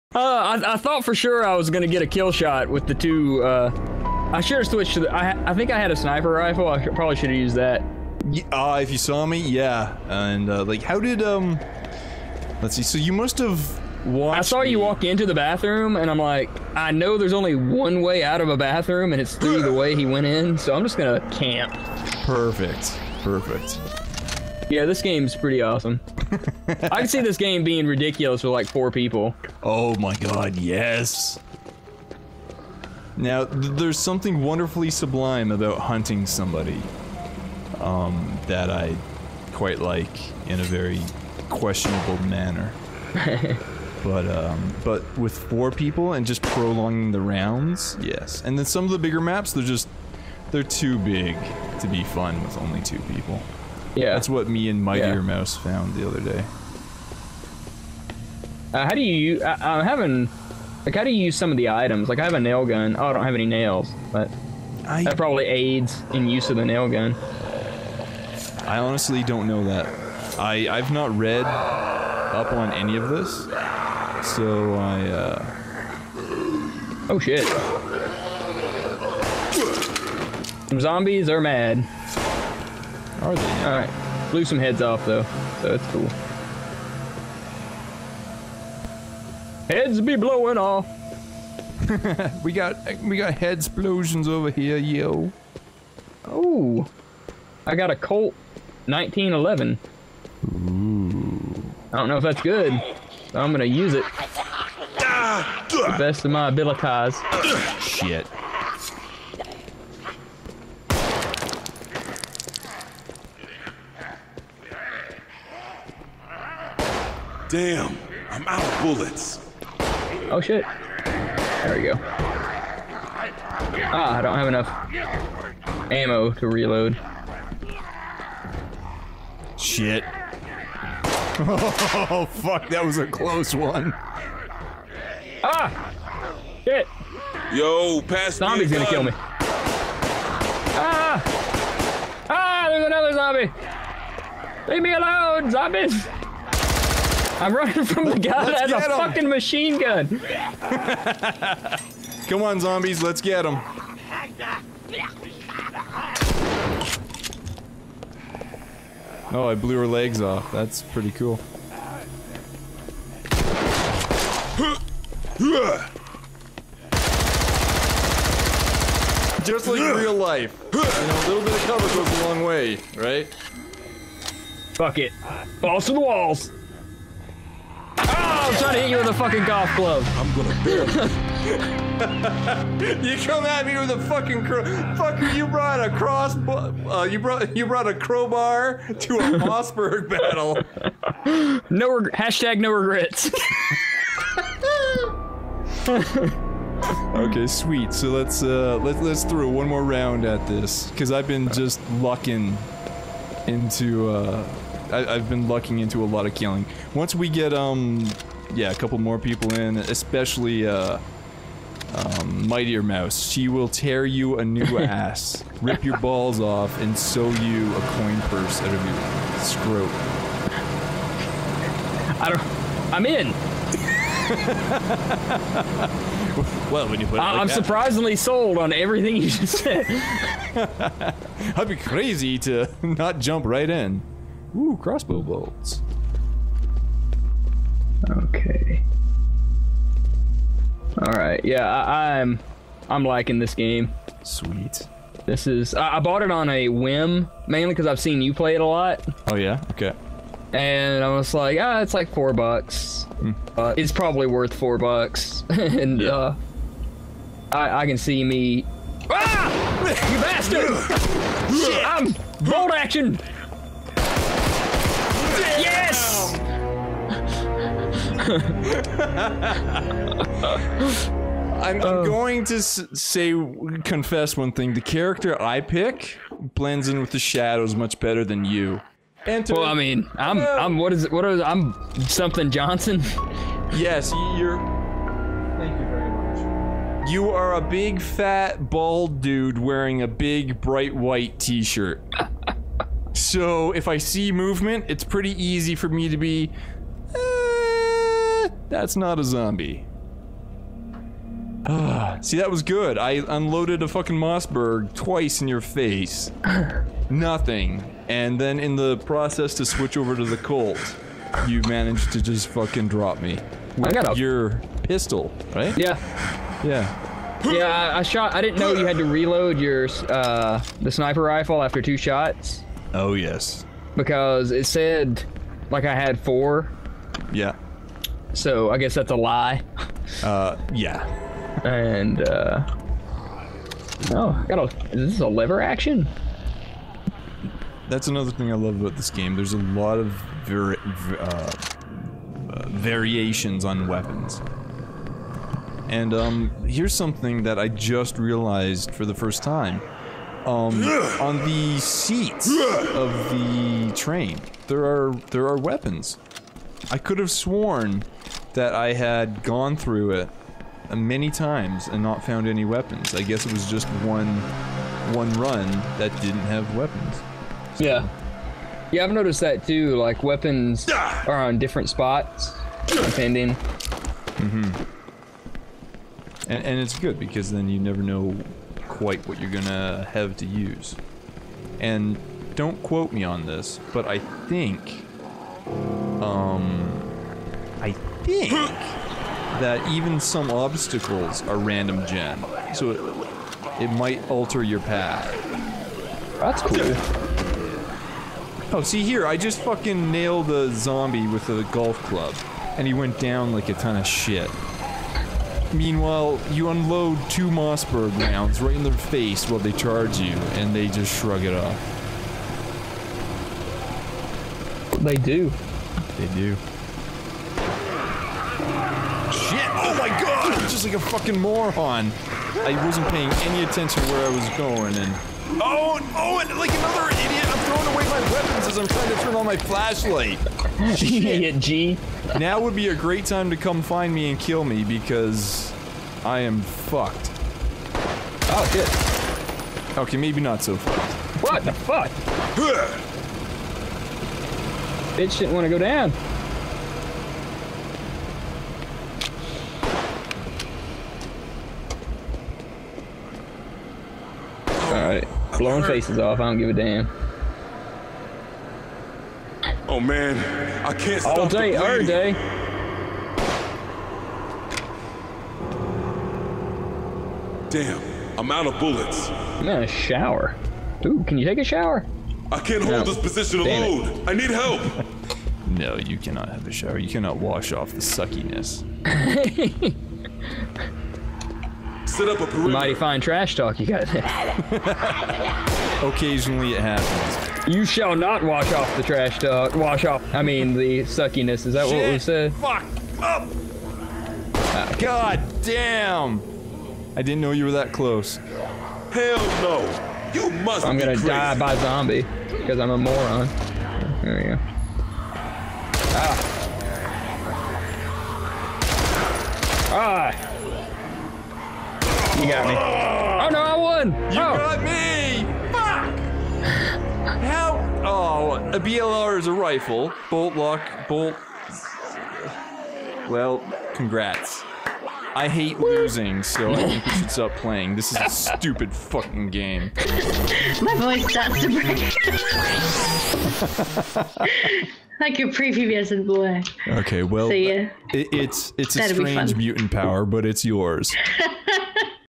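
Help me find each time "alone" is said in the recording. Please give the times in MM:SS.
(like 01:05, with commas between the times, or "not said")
02:24, 07:53.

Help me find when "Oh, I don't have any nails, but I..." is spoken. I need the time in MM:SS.
01:02.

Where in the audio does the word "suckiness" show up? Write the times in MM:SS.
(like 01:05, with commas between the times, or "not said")
07:57, 08:11.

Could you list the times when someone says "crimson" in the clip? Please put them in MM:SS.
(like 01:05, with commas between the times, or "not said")
not said.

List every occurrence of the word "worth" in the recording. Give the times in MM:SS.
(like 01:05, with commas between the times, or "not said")
04:14.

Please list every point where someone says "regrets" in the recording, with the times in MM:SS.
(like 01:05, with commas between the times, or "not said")
03:12.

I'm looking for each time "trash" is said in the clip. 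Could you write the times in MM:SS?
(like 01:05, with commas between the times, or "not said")
08:03, 08:09.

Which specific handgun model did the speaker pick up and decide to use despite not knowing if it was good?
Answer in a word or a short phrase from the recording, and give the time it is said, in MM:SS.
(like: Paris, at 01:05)
Colt 1911, at 01:37.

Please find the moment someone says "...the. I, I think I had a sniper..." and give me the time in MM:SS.
00:05.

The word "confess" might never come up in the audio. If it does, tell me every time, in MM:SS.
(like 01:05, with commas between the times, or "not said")
04:33.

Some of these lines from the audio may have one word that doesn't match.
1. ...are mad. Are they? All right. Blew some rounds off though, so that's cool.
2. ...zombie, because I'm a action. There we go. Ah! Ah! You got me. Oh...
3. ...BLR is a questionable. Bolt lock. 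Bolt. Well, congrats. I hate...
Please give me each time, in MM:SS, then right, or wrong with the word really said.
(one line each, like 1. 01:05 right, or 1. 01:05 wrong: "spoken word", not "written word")
1. 01:21 wrong: "heads", not "rounds"
2. 08:21 wrong: "moron", not "action"
3. 08:38 wrong: "rifle", not "questionable".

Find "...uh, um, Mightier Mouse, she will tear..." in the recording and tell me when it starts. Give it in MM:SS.
03:30.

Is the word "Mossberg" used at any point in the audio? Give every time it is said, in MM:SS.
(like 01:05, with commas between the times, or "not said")
03:09, 05:04, 06:47.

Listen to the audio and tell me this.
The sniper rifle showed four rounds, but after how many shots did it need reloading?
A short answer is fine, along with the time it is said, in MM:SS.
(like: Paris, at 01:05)
2, at 05:21.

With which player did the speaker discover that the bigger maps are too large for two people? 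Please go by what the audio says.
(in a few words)
Mightier Mouse.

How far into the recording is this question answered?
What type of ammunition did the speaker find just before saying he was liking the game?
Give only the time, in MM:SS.
03:54.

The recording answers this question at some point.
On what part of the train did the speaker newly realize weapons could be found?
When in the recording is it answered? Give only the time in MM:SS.
05:51.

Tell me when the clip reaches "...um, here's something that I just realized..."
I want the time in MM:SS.
05:46.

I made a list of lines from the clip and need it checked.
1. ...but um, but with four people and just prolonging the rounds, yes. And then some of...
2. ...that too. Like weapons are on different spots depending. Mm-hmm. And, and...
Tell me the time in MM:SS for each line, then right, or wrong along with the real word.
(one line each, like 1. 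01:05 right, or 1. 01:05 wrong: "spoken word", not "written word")
1. 00:44 right
2. 06:09 right.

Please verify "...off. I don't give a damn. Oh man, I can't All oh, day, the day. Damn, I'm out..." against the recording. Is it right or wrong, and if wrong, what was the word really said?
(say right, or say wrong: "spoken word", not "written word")
right.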